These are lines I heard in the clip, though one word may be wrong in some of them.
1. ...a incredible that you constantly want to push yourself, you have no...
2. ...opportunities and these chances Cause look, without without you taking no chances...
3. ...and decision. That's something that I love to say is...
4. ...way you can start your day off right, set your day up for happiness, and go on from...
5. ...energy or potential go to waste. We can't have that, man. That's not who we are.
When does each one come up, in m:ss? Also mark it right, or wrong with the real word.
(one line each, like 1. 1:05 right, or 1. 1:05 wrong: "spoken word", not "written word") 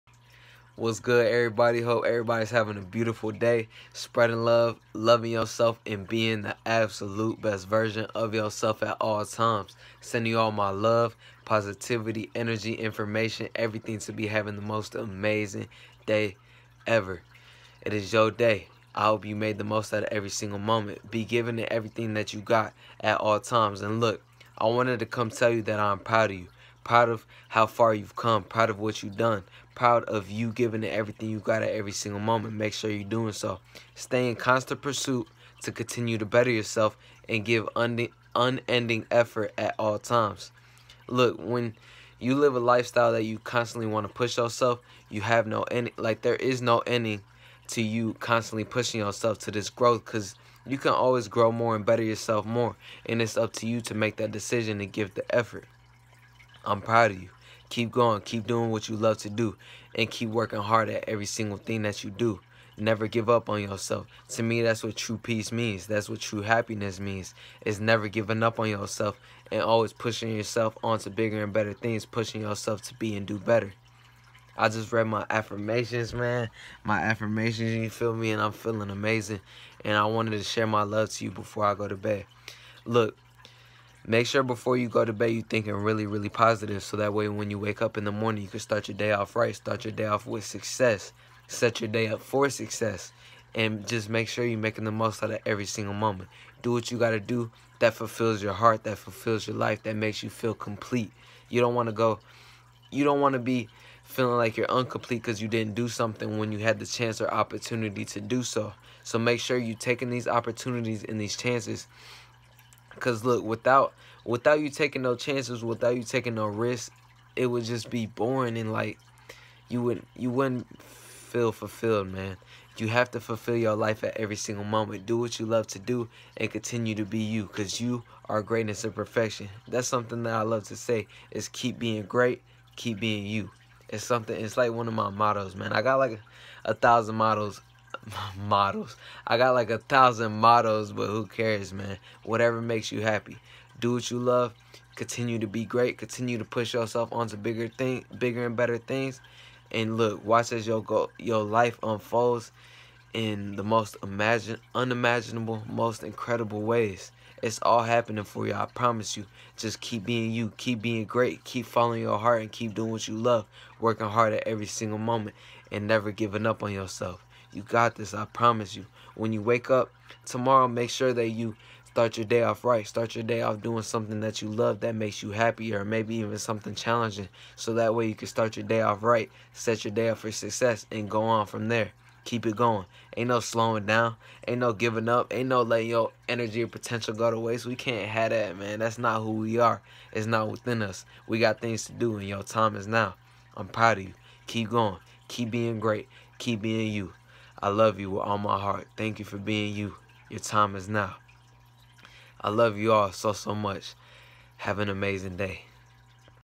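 1. 0:42 wrong: "lifestyle", not "incredible"
2. 1:50 right
3. 2:08 wrong: "perfection", not "decision"
4. 2:57 wrong: "success", not "happiness"
5. 3:06 right.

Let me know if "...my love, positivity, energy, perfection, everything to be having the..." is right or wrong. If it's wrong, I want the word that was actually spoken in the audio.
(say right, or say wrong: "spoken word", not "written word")
wrong: "information", not "perfection".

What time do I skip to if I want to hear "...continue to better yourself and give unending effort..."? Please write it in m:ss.
0:35.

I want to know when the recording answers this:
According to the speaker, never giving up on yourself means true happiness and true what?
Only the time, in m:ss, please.
1:05.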